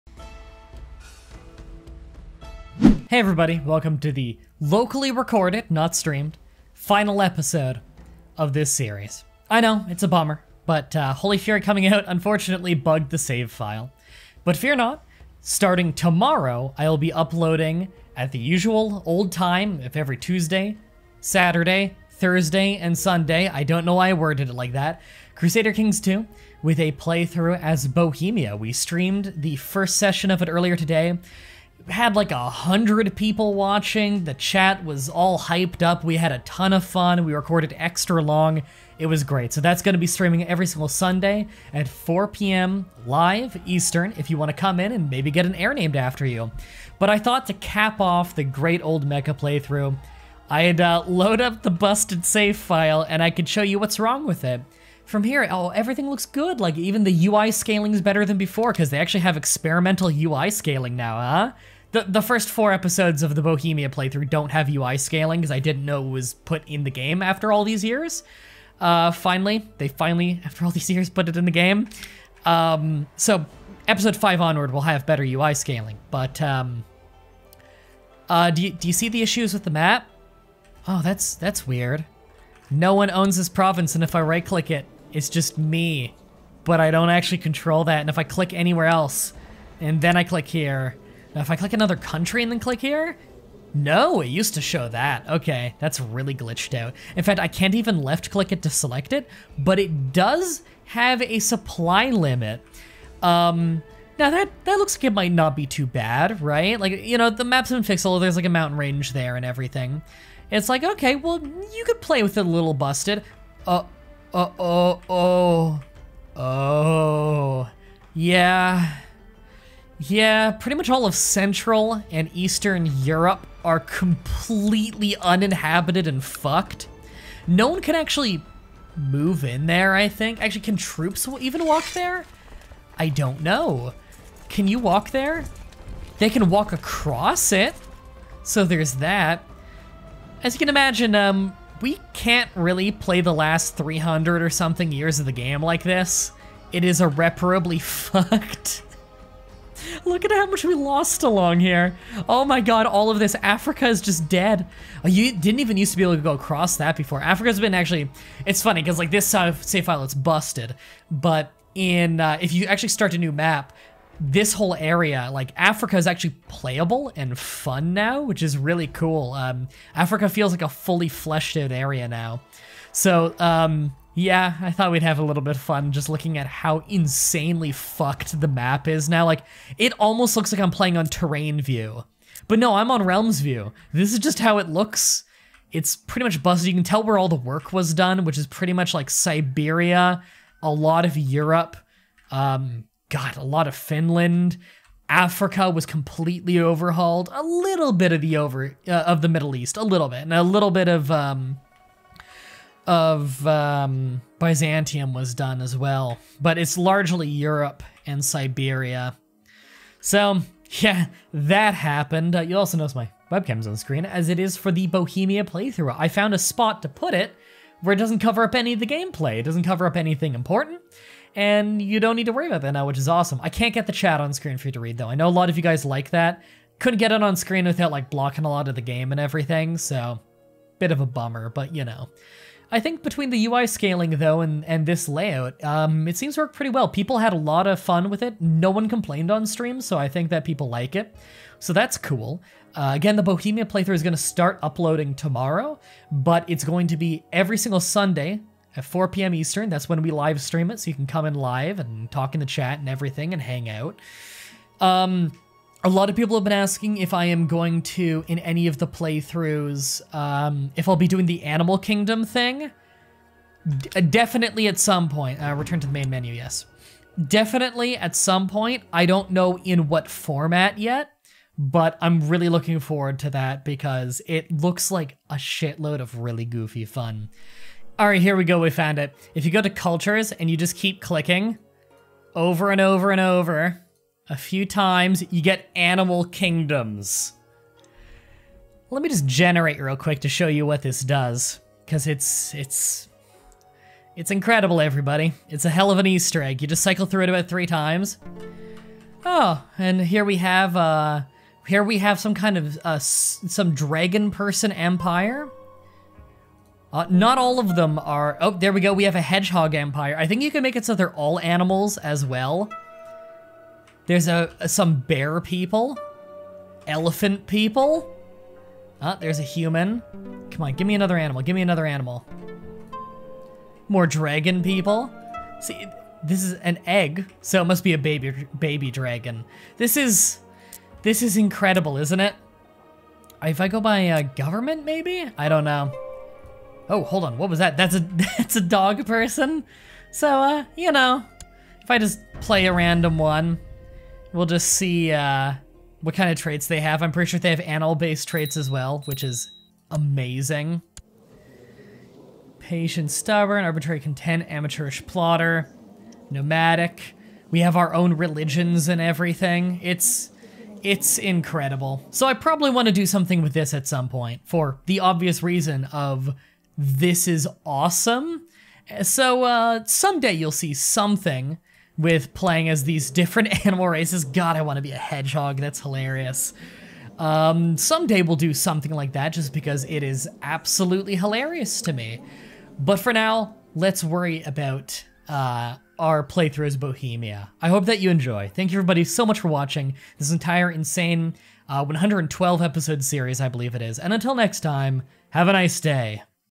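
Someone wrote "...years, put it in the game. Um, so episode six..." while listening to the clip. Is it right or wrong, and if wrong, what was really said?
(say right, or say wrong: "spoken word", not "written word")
wrong: "five", not "six".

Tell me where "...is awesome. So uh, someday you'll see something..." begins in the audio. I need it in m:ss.
6:07.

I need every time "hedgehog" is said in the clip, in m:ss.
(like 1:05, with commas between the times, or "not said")
5:09, 6:14.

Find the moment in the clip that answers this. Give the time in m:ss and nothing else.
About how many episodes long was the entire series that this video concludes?
6:31.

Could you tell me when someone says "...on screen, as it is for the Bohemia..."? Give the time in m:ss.
3:33.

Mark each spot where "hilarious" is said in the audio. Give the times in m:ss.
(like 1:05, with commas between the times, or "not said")
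6:15, 6:21.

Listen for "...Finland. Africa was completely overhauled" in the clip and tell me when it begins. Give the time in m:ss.
3:13.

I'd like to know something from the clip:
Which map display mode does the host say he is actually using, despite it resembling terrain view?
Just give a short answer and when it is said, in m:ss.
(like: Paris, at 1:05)
Realms view, at 3:03.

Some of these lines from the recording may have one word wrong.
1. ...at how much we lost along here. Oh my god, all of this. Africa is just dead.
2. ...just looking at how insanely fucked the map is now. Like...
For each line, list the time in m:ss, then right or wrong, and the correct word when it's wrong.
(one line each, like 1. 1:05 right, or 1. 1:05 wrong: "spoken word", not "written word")
1. 2:30 right
2. 2:55 right.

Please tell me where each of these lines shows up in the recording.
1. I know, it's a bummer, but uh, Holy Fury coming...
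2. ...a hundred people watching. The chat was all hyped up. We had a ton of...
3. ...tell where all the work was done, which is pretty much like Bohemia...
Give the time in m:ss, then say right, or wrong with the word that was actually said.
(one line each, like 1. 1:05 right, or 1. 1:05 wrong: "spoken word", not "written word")
1. 0:09 right
2. 0:32 right
3. 3:06 wrong: "Siberia", not "Bohemia".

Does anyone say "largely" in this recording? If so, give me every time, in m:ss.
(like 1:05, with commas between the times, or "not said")
3:26.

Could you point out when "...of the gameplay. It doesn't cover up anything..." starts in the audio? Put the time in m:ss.
3:38.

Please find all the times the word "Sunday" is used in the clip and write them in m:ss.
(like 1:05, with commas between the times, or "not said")
0:22, 0:40, 4:07.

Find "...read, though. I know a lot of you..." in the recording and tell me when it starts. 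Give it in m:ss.
3:44.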